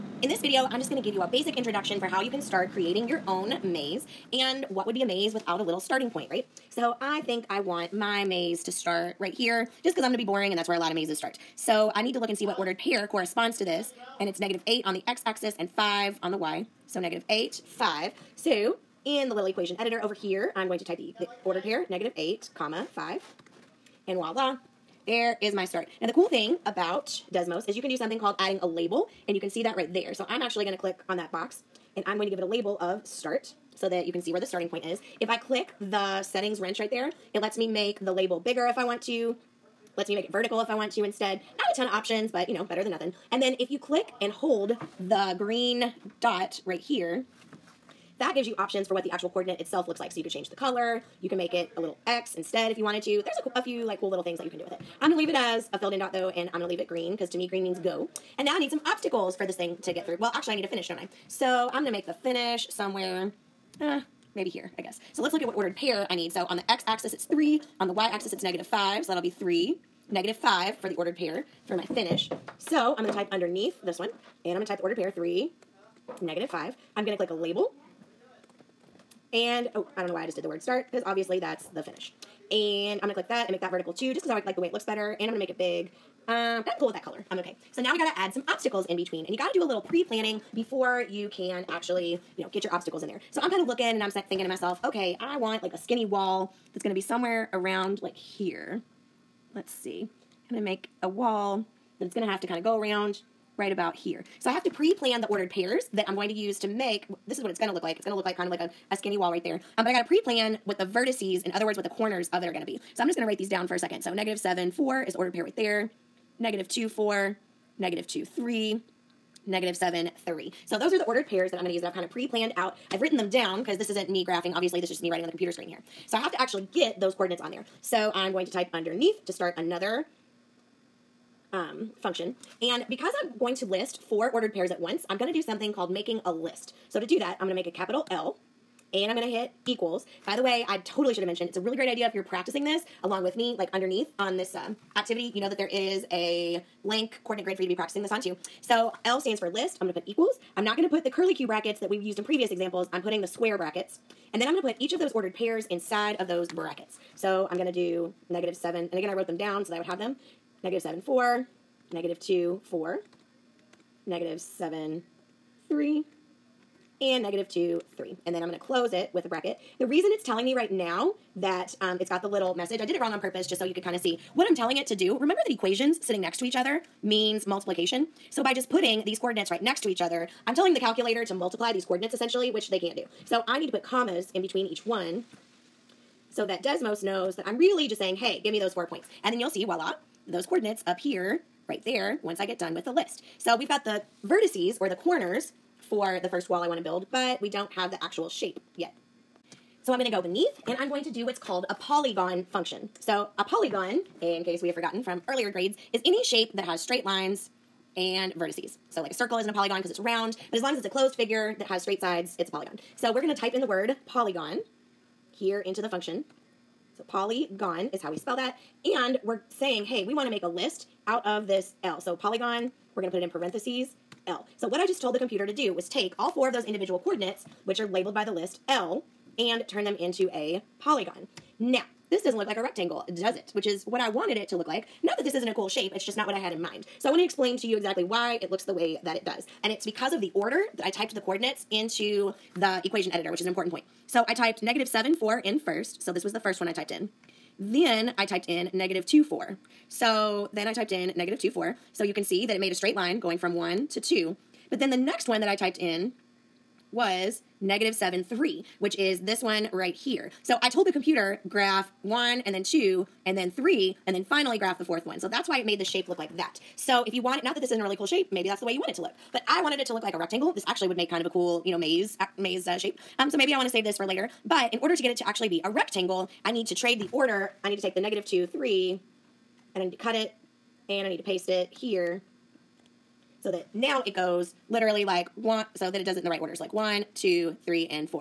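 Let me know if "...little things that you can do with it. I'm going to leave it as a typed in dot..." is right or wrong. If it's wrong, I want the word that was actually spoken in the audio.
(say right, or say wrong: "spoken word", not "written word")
wrong: "filled", not "typed".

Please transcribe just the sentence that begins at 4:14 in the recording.
But then the next one that I typed in was negative 7, 3, which is this one right here.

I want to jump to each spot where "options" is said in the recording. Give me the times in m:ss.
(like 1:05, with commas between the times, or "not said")
0:41, 0:48.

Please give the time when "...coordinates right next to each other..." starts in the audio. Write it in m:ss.
2:59.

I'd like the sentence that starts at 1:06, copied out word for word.
So on the X axis, it's three.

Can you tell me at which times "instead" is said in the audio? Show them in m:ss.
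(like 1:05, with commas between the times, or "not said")
0:41, 0:52.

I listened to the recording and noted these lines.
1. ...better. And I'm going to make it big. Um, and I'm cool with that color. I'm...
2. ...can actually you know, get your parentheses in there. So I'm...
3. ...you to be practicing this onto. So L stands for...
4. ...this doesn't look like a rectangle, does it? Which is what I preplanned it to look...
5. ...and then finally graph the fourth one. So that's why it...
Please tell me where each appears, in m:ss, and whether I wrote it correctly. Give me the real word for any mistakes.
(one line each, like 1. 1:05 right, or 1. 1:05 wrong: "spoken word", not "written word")
1. 1:24 right
2. 1:31 wrong: "obstacles", not "parentheses"
3. 2:27 right
4. 3:52 wrong: "wanted", not "preplanned"
5. 4:24 right.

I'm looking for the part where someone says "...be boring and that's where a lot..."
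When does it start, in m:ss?
0:10.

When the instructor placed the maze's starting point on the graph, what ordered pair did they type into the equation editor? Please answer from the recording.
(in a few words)
(-8, 5).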